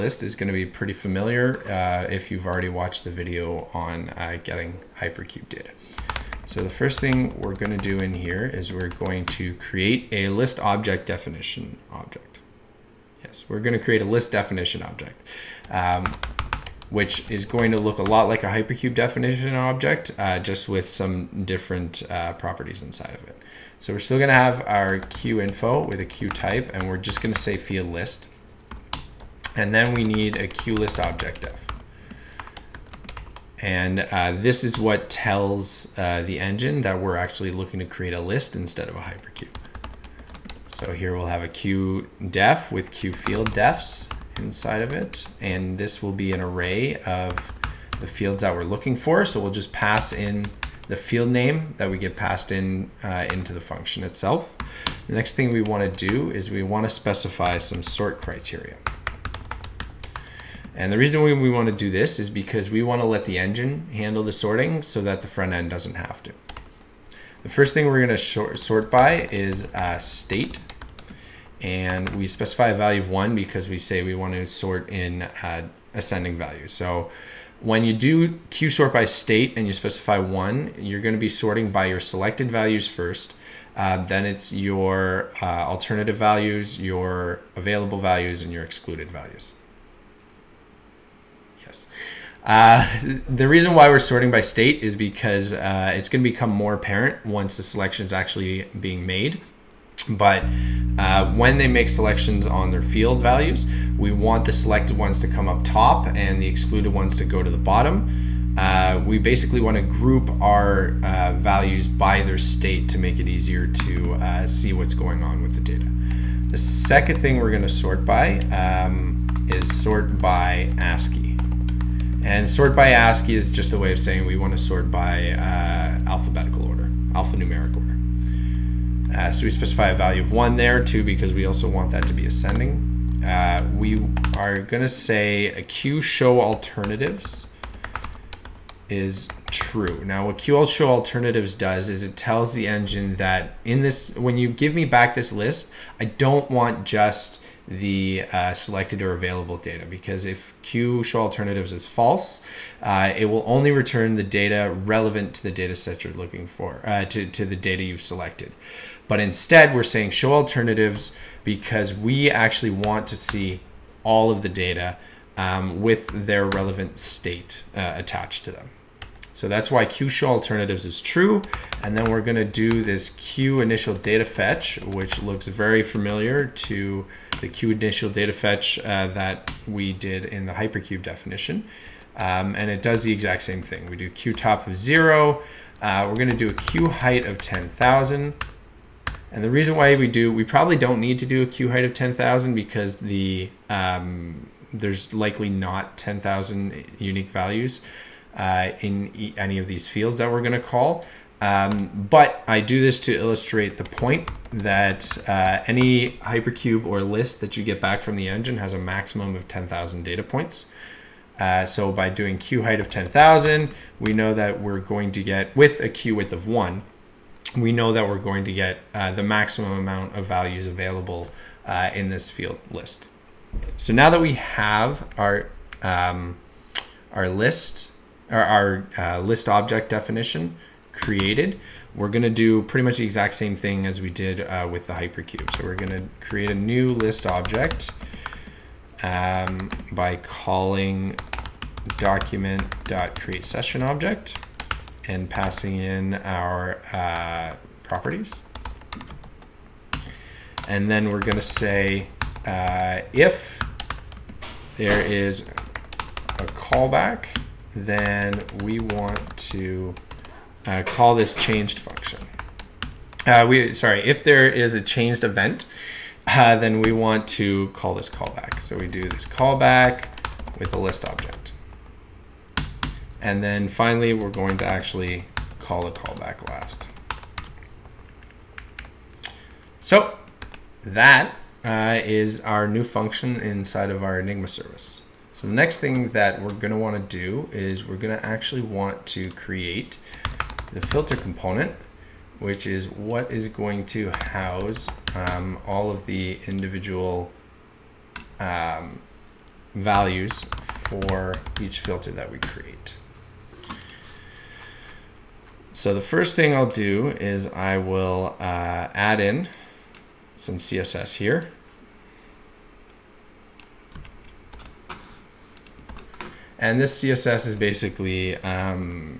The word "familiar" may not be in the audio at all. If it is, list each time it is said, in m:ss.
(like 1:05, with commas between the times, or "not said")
0:00, 2:55.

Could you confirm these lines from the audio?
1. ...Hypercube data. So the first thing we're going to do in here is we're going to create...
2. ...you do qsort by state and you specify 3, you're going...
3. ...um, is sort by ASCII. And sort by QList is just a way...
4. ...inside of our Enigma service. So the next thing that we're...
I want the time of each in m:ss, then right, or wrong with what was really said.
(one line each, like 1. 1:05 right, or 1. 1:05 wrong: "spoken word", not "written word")
1. 0:04 right
2. 1:17 wrong: "1", not "3"
3. 1:58 wrong: "ASCII", not "QList"
4. 4:43 right.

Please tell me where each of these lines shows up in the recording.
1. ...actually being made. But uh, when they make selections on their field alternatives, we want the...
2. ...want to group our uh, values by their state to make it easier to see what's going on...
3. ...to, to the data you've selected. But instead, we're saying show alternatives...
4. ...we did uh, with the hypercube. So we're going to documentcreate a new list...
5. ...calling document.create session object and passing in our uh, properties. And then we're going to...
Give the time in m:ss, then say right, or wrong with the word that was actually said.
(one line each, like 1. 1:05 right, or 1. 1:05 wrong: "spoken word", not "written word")
1. 1:38 wrong: "values", not "alternatives"
2. 1:49 right
3. 2:37 right
4. 3:54 wrong: "create", not "documentcreate"
5. 4:00 right.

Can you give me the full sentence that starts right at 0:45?
And this will be an array of the fields that we're looking for.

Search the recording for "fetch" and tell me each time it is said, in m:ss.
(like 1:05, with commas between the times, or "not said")
2:54, 2:58.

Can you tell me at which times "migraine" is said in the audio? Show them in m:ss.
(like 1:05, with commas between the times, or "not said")
not said.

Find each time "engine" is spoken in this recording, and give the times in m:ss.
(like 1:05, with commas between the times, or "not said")
0:36, 1:03, 2:22, 3:28.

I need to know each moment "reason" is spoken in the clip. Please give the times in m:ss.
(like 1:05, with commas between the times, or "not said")
1:00, 1:33, 3:09.